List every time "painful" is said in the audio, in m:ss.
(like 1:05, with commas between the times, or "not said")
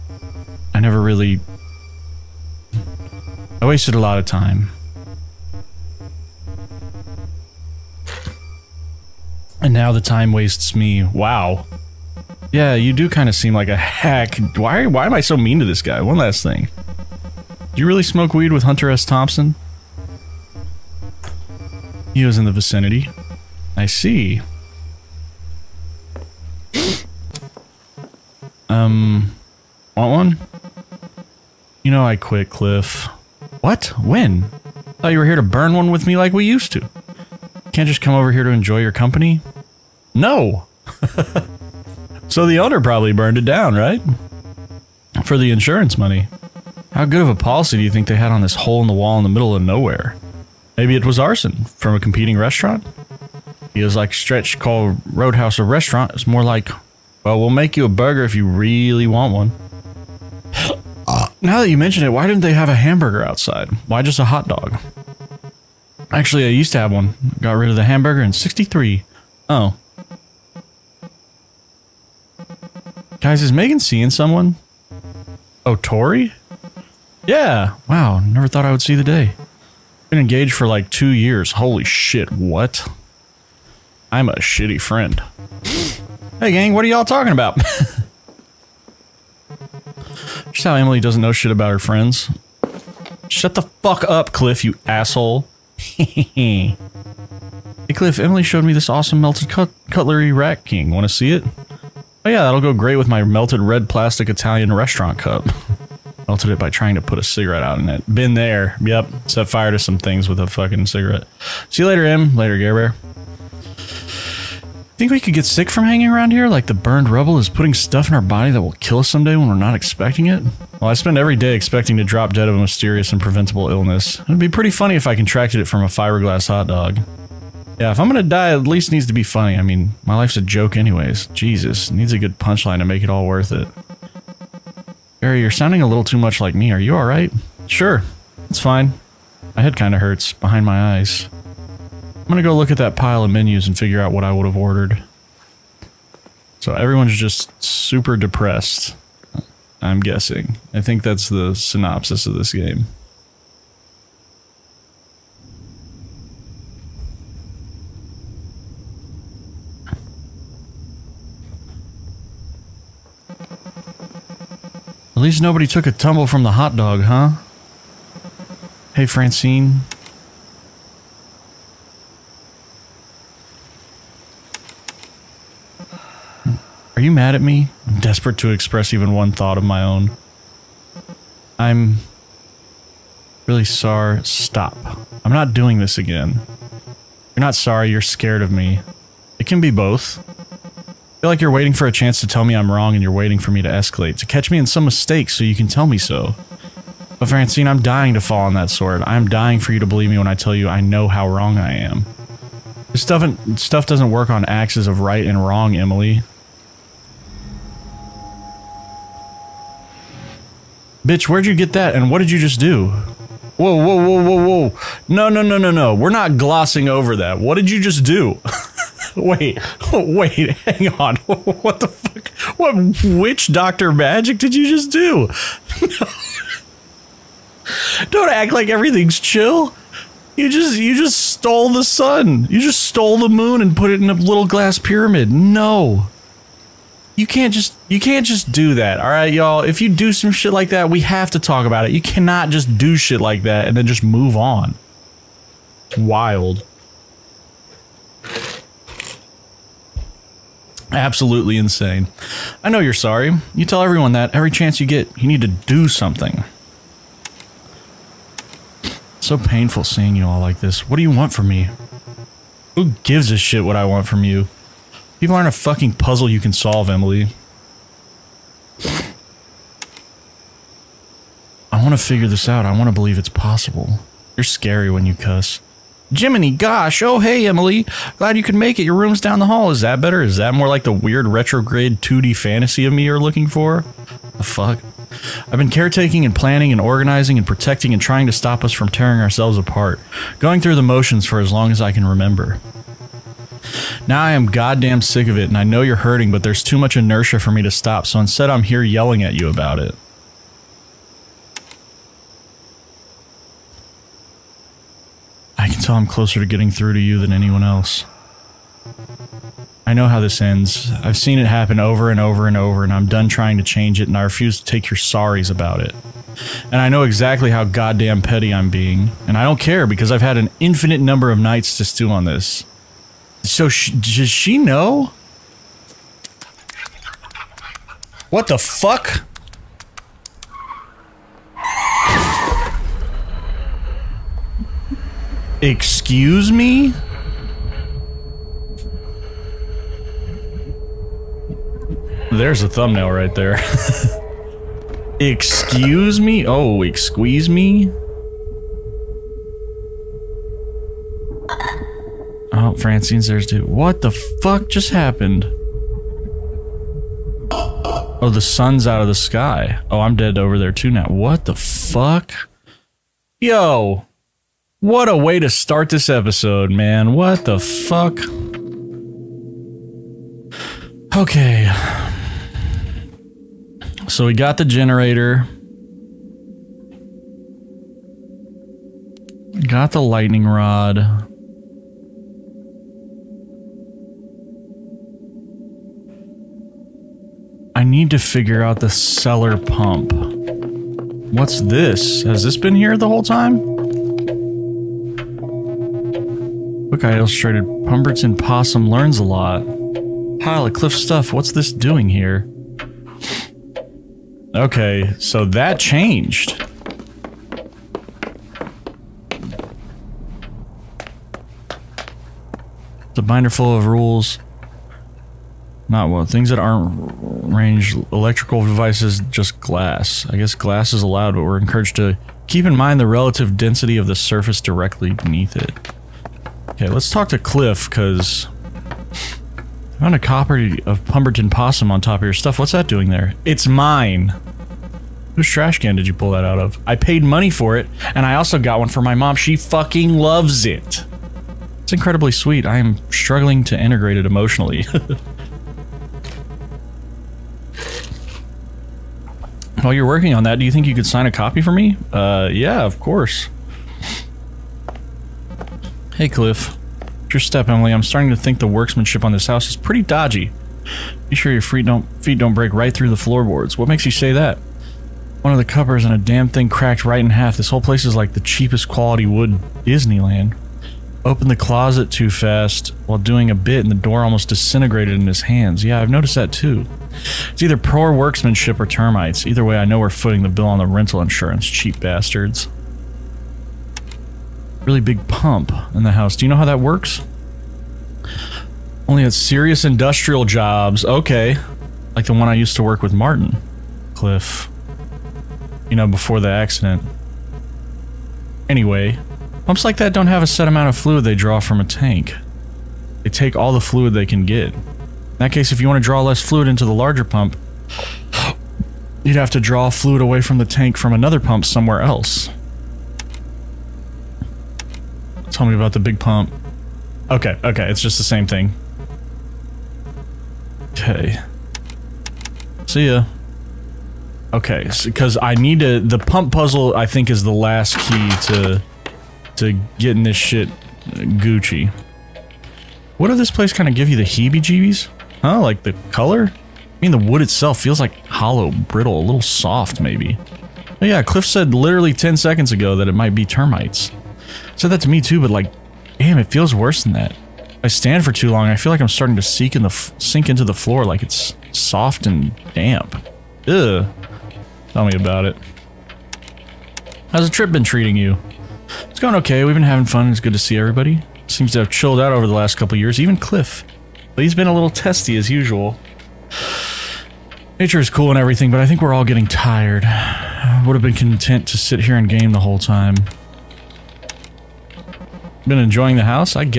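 4:19.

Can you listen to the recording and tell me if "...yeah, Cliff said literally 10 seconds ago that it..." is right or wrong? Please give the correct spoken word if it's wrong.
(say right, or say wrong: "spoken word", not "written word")
right.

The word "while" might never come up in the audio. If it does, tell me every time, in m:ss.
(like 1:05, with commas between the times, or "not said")
7:29, 7:53.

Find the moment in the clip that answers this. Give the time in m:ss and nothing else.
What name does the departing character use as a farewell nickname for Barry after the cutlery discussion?
1:52.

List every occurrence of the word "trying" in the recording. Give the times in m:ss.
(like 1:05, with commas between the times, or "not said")
1:46, 4:48, 5:13.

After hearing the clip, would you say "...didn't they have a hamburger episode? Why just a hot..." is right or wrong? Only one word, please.
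wrong.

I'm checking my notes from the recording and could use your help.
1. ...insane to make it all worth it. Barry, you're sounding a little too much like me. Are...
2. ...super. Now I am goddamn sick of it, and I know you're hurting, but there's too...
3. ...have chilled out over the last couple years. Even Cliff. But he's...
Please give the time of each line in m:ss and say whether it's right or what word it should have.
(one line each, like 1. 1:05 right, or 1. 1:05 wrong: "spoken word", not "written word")
1. 2:12 wrong: "punchline", not "insane"
2. 4:52 wrong: "remember", not "super"
3. 9:21 right.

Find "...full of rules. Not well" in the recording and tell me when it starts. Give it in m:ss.
6:53.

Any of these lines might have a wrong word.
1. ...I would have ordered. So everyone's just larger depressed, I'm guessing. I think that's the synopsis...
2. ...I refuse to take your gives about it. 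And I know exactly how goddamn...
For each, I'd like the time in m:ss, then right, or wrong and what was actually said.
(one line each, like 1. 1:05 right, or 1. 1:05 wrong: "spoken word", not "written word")
1. 2:24 wrong: "super", not "larger"
2. 5:14 wrong: "sorries", not "gives".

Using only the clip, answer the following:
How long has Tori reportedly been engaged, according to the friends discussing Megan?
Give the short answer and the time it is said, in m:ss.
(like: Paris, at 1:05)
2 years, at 1:20.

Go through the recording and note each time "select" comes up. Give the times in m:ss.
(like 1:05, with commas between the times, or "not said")
not said.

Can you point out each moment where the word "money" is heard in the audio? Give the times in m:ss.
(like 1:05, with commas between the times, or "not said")
0:45, 7:17.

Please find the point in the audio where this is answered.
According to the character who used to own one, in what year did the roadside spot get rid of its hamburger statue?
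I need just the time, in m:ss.
1:08.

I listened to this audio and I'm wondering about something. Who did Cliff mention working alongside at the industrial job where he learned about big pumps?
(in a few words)
Martin.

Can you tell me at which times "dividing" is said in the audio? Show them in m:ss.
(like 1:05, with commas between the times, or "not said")
not said.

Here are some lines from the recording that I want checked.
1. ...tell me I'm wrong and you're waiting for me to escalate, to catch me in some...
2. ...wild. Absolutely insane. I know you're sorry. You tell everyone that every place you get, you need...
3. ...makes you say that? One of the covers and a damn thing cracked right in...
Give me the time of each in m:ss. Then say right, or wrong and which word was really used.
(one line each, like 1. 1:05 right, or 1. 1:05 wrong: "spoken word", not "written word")
1. 3:12 right
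2. 4:05 wrong: "chance", not "place"
3. 7:43 right.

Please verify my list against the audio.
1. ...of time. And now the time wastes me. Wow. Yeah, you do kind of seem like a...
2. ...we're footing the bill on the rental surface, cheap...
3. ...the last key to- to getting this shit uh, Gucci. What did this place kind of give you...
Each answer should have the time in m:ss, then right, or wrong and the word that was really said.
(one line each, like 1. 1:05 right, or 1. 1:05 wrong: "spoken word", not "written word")
1. 0:04 right
2. 8:00 wrong: "insurance", not "surface"
3. 8:47 right.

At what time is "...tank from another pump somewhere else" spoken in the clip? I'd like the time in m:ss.
8:30.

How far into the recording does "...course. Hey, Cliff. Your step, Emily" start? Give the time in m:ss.
7:32.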